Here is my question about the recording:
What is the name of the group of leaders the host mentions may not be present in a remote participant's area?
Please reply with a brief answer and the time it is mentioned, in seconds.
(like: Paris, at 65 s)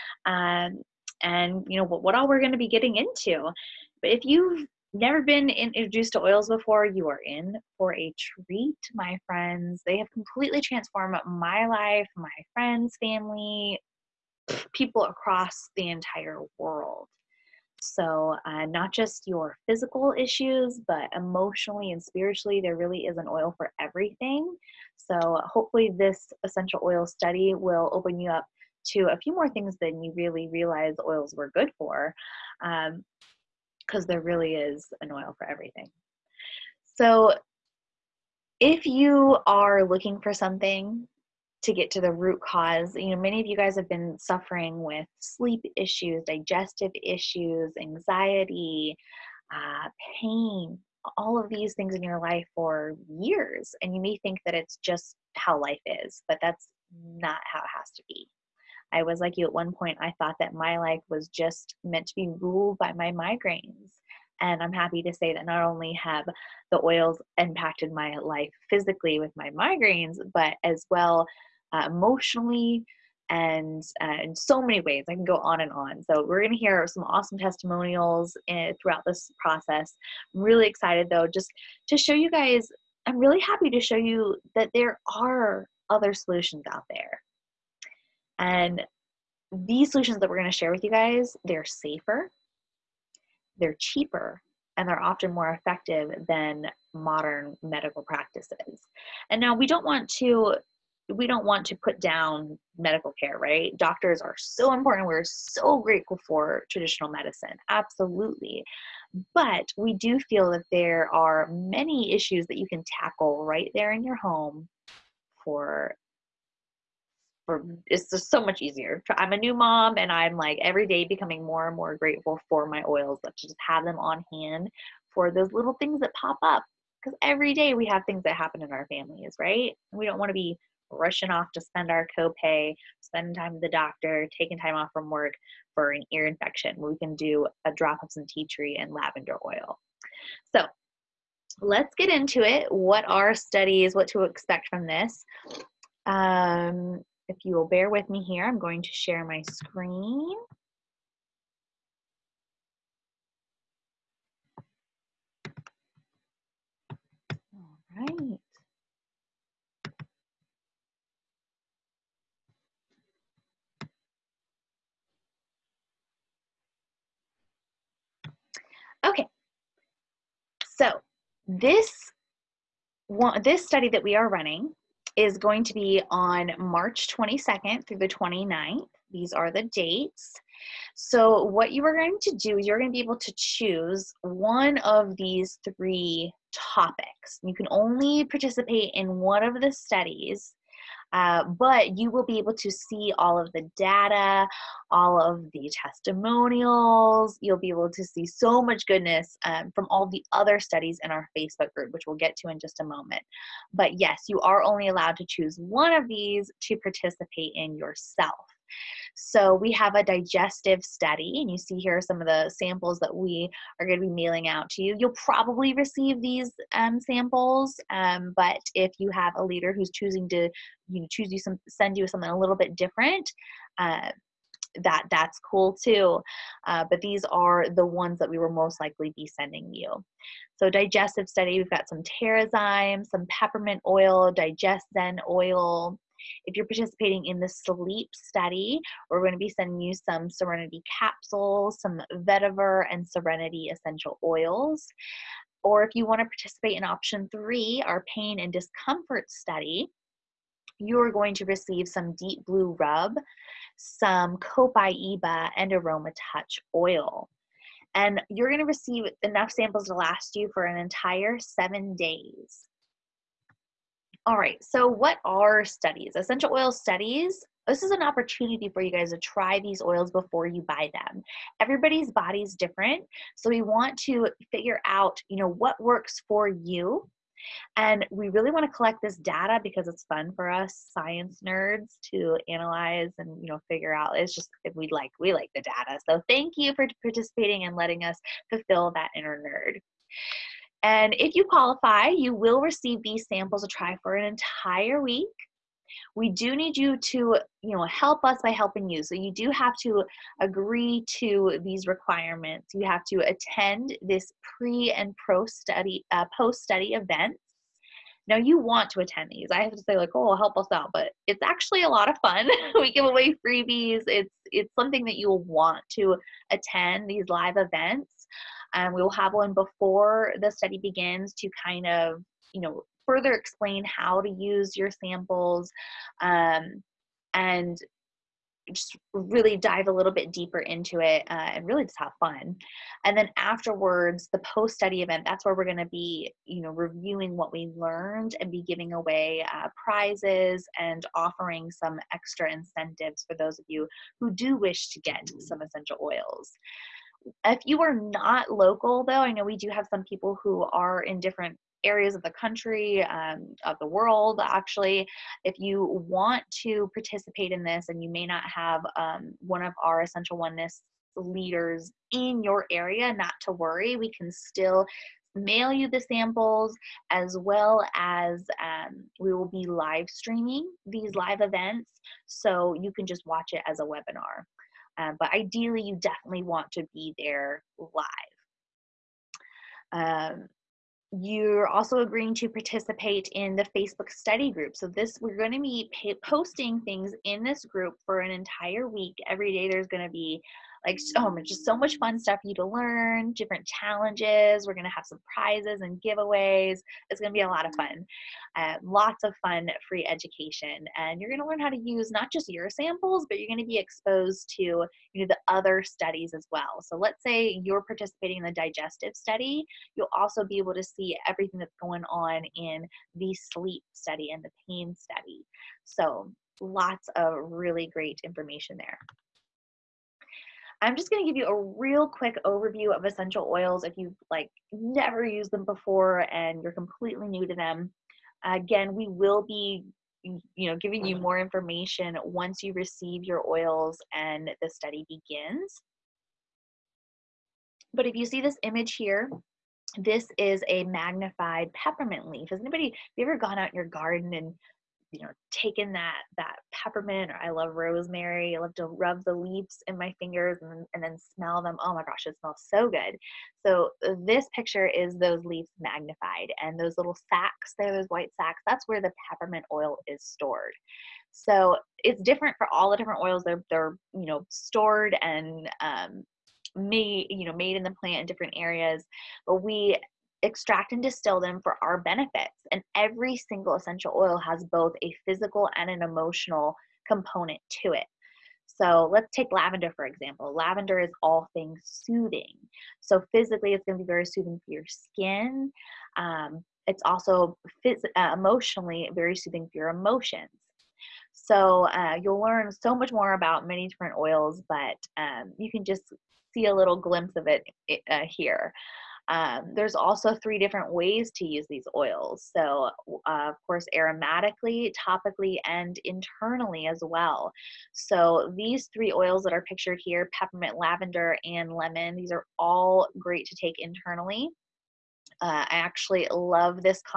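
Essential Oneness, at 360 s.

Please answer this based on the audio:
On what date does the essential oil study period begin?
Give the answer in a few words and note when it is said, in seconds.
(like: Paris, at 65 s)
March 22, at 176 s.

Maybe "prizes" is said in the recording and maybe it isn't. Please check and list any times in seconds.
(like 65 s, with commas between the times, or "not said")
339 s, 395 s.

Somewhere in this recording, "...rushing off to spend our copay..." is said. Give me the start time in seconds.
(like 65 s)
130 s.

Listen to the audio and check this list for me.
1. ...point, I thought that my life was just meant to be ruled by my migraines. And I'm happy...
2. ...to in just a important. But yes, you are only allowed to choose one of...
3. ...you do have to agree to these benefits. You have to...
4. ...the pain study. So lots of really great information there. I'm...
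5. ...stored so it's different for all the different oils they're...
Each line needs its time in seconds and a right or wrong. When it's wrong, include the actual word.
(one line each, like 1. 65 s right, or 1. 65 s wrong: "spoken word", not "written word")
1. 59 s right
2. 202 s wrong: "moment", not "important"
3. 299 s wrong: "requirements", not "benefits"
4. 414 s right
5. 460 s right.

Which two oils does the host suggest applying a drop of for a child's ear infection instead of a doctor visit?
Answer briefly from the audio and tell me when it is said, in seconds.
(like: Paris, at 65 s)
tea tree and lavender, at 138 s.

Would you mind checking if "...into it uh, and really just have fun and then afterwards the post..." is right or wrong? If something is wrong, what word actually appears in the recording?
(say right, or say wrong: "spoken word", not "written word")
right.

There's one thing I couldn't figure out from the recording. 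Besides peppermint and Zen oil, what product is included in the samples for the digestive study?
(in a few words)
TerraZyme.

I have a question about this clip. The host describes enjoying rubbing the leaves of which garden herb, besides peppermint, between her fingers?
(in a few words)
rosemary.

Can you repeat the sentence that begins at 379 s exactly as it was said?
Um, you're also agreeing to participate in the Facebook study group.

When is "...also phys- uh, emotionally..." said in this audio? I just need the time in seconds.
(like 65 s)
487 s.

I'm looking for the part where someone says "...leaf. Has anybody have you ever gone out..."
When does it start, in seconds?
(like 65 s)
442 s.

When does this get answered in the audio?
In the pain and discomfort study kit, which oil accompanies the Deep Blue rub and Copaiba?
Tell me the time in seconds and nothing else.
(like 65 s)
255 s.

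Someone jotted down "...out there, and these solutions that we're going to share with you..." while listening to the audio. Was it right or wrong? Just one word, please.
right.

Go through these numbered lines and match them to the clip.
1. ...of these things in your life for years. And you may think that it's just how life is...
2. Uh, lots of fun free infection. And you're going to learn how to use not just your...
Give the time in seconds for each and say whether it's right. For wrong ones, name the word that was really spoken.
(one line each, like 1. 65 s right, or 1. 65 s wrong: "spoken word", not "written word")
1. 51 s right
2. 398 s wrong: "education", not "infection".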